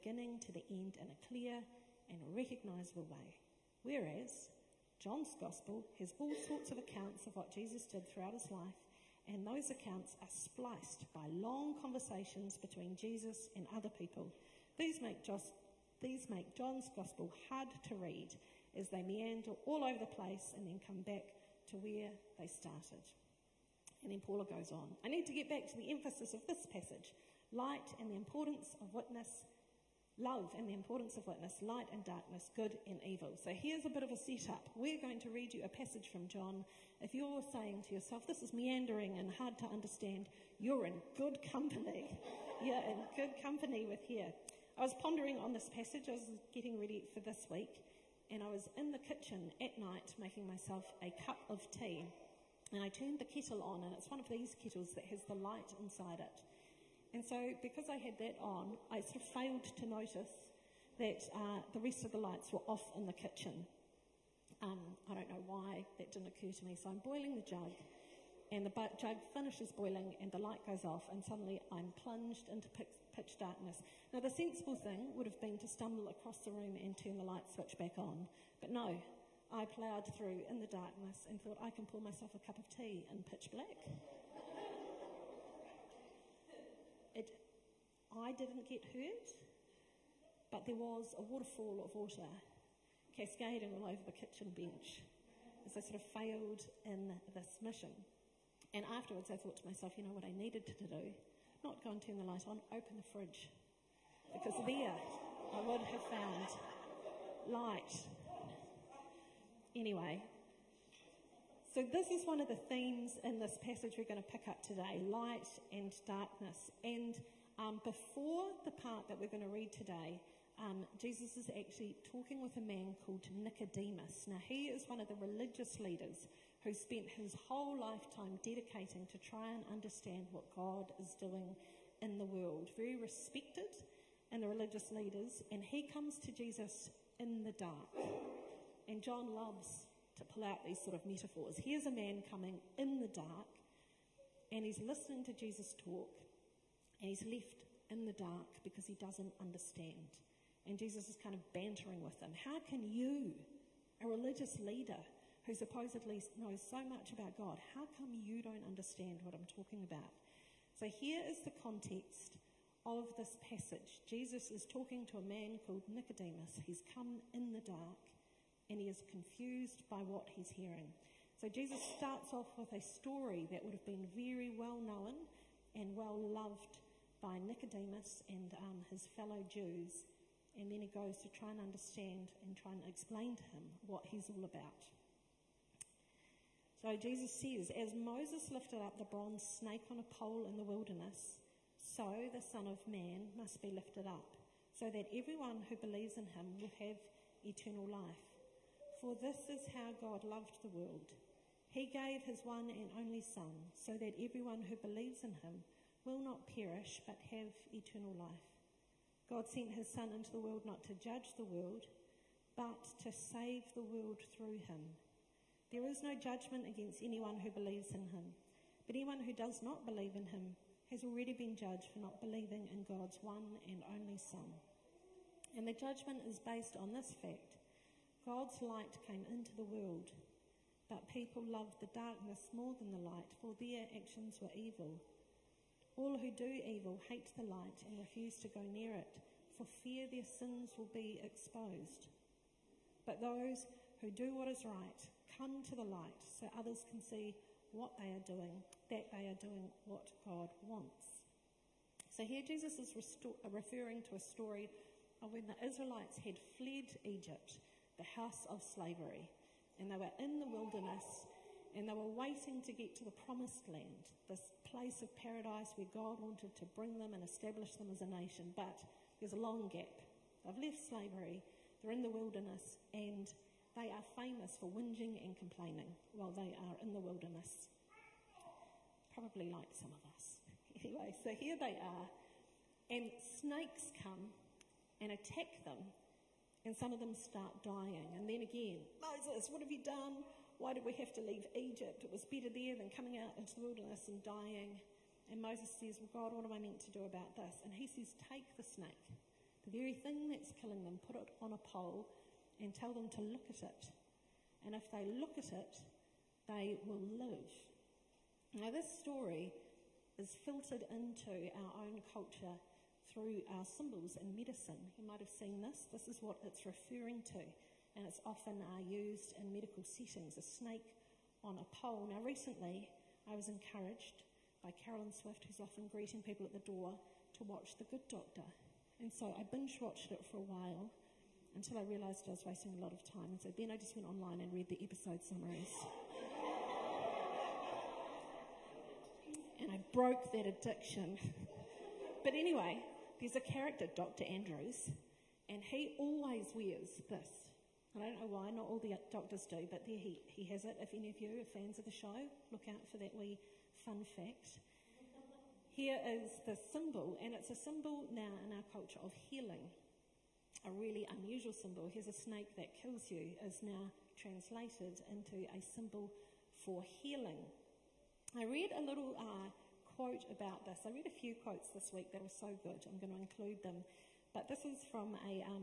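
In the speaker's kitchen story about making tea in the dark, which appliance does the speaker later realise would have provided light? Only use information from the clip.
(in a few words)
The fridge.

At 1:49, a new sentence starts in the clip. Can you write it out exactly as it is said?
Anyway, so this is one of the themes in this passage we're going to pick up today light and darkness.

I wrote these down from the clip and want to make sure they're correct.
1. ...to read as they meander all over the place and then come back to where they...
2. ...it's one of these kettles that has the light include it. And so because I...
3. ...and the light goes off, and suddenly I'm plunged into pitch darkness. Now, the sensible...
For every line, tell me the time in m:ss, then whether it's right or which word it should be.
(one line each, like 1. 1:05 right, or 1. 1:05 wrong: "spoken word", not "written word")
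1. 0:17 right
2. 0:53 wrong: "inside", not "include"
3. 1:10 right.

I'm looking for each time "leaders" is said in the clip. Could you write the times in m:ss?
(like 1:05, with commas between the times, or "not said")
2:05, 2:14, 2:34.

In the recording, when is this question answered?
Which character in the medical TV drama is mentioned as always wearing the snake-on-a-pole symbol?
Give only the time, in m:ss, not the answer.
5:43.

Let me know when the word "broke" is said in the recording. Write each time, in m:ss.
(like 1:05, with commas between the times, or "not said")
5:39.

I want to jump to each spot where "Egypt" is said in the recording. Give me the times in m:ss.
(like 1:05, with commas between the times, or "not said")
4:17, 4:51.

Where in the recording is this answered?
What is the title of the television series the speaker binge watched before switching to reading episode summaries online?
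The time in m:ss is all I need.
5:27.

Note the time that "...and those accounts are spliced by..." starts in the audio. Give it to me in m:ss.
0:09.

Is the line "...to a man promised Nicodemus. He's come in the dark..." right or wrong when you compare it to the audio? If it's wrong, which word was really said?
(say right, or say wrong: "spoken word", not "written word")
wrong: "called", not "promised".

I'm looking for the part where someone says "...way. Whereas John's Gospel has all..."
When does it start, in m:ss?
0:03.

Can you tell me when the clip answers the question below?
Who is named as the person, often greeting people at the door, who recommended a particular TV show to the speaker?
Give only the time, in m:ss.
5:24.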